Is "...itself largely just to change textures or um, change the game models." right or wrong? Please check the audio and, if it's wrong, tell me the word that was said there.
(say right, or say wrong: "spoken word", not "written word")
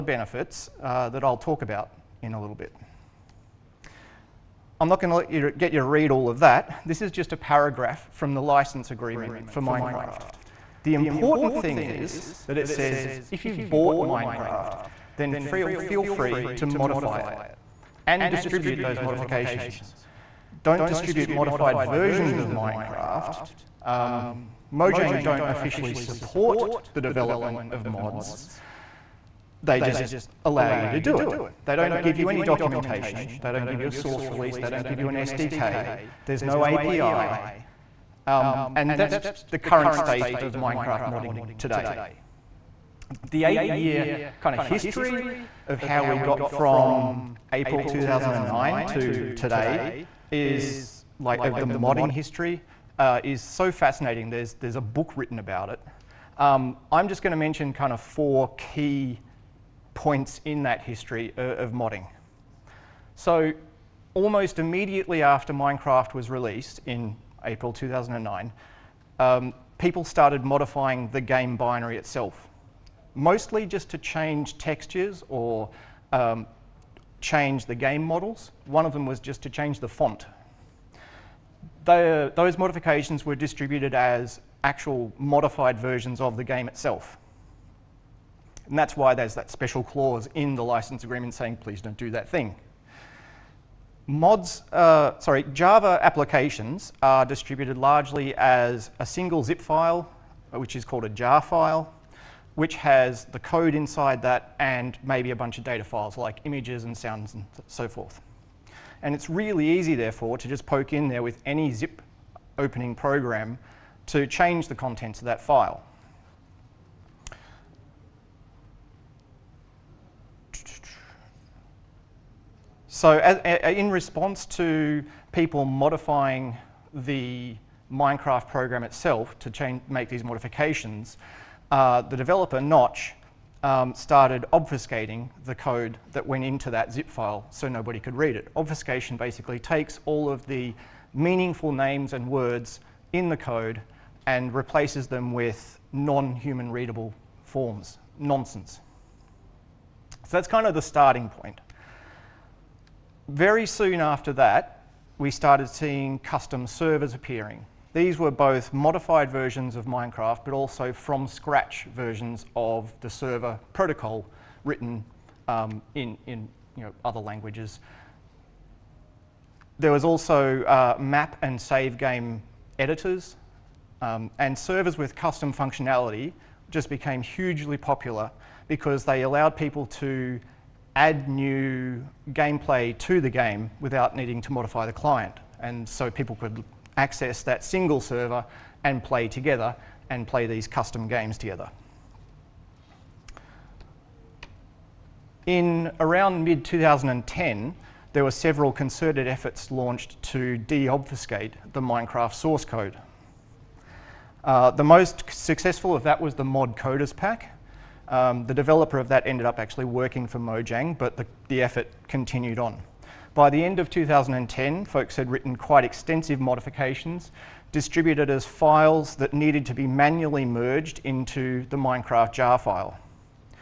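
wrong: "mostly", not "largely".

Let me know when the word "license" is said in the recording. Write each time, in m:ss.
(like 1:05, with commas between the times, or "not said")
0:08, 1:30.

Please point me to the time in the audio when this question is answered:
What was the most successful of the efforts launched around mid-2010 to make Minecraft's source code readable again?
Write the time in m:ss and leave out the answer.
3:26.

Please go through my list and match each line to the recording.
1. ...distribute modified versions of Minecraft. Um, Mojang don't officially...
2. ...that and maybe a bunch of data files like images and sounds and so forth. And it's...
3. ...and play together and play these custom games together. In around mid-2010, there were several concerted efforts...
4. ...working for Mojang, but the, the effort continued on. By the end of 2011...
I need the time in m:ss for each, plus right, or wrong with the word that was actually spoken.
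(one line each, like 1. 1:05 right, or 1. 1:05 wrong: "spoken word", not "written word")
1. 0:20 right
2. 1:44 right
3. 3:08 right
4. 3:29 wrong: "2010", not "2011".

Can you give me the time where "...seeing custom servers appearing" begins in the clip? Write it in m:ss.
2:35.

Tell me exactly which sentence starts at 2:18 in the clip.
Obfuscation basically takes all of the meaningful names and words in the code and replaces them with non-human readable forms, nonsense.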